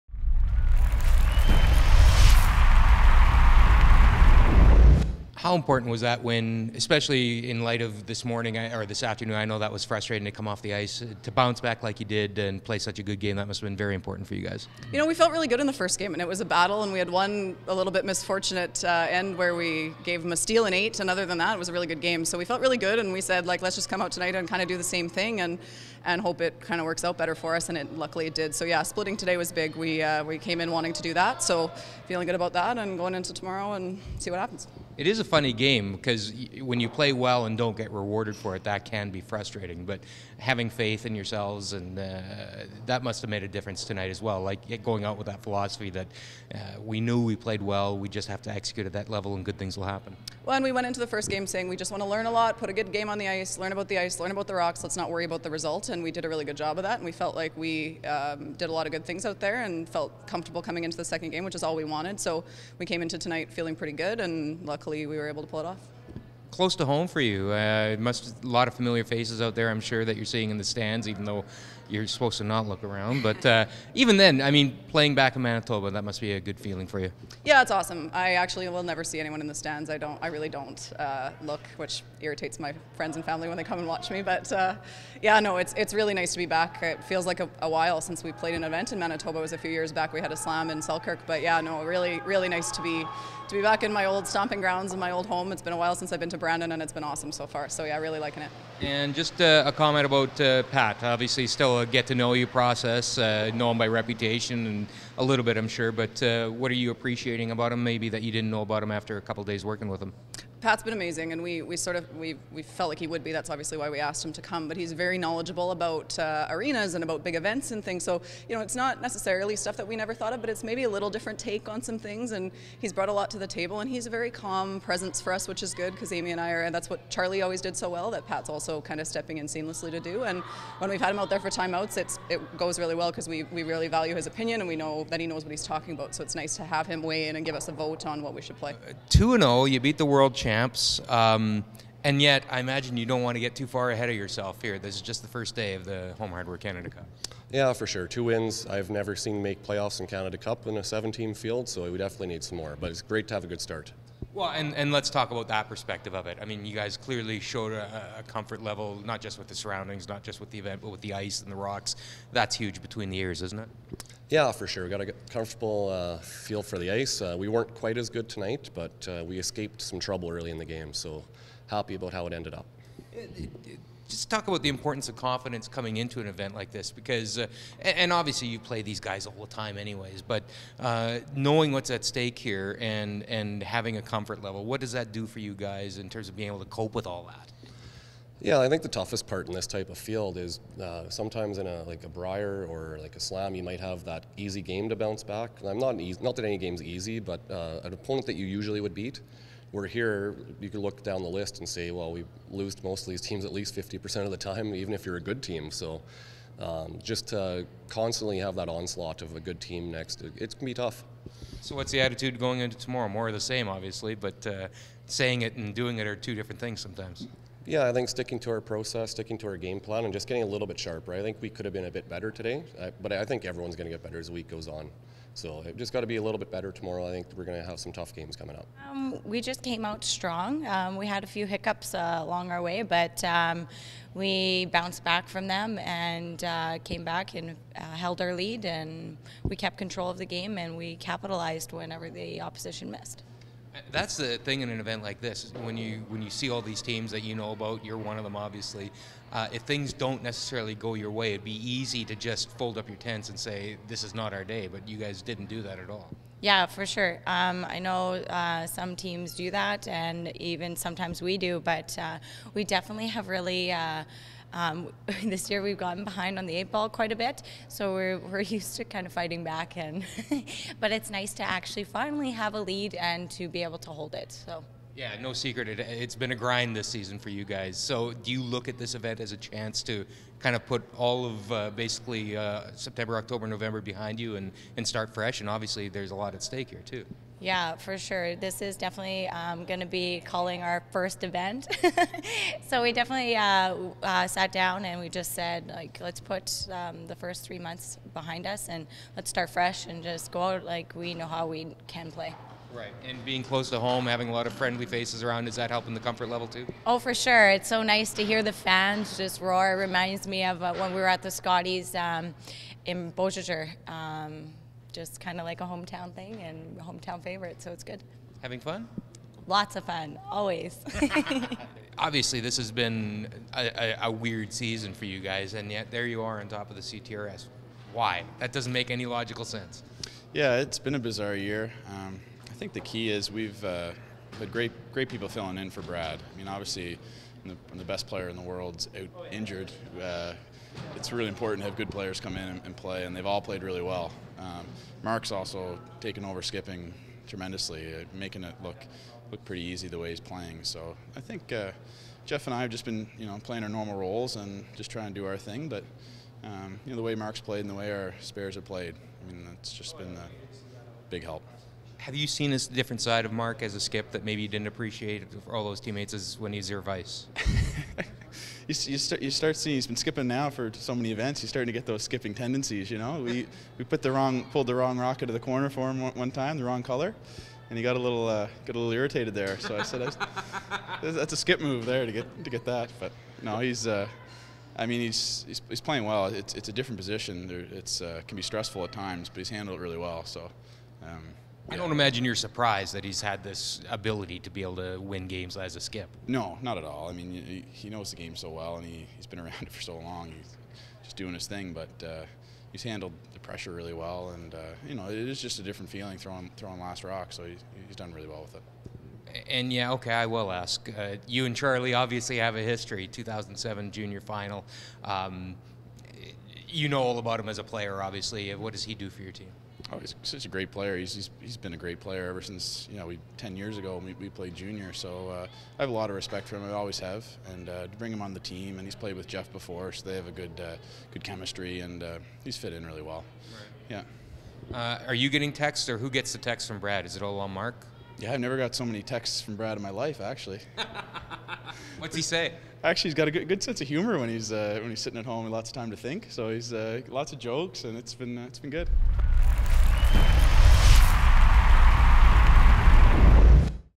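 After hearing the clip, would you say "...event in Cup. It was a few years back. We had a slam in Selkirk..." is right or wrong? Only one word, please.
wrong.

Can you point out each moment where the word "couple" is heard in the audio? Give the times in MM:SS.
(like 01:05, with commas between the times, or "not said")
01:49.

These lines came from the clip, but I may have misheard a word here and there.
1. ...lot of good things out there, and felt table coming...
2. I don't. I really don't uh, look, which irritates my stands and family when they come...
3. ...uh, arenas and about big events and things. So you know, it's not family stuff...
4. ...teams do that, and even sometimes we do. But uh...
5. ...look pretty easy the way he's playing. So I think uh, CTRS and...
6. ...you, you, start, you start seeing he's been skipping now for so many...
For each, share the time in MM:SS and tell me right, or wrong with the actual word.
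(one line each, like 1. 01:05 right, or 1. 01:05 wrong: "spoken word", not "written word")
1. 00:58 wrong: "comfortable", not "table"
2. 01:19 wrong: "friends", not "stands"
3. 01:56 wrong: "necessarily", not "family"
4. 04:18 right
5. 05:49 wrong: "Jeff", not "CTRS"
6. 06:08 right.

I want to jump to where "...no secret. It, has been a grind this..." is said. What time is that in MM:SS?
04:35.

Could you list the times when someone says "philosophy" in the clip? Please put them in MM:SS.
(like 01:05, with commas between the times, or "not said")
00:45.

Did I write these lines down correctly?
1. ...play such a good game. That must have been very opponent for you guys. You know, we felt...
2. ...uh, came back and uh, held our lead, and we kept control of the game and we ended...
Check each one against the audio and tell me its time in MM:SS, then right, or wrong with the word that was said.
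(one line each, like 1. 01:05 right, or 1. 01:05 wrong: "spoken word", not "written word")
1. 00:12 wrong: "important", not "opponent"
2. 03:56 wrong: "capitalized", not "ended".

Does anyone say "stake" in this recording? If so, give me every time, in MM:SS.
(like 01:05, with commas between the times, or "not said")
03:02, 04:46.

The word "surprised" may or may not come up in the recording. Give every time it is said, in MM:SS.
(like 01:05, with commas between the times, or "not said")
06:32.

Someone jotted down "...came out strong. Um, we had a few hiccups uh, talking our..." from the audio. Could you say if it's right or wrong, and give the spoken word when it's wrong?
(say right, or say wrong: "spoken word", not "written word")
wrong: "along", not "talking".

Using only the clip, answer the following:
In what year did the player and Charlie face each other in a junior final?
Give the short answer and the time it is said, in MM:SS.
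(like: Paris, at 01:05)
2007, at 06:53.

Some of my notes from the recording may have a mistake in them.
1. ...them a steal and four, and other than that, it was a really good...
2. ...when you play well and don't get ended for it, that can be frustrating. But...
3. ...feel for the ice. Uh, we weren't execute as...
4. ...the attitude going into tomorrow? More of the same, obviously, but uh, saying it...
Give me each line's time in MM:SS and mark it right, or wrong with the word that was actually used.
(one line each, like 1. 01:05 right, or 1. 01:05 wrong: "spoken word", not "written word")
1. 00:20 wrong: "eight", not "four"
2. 00:36 wrong: "rewarded", not "ended"
3. 02:46 wrong: "quite", not "execute"
4. 03:31 right.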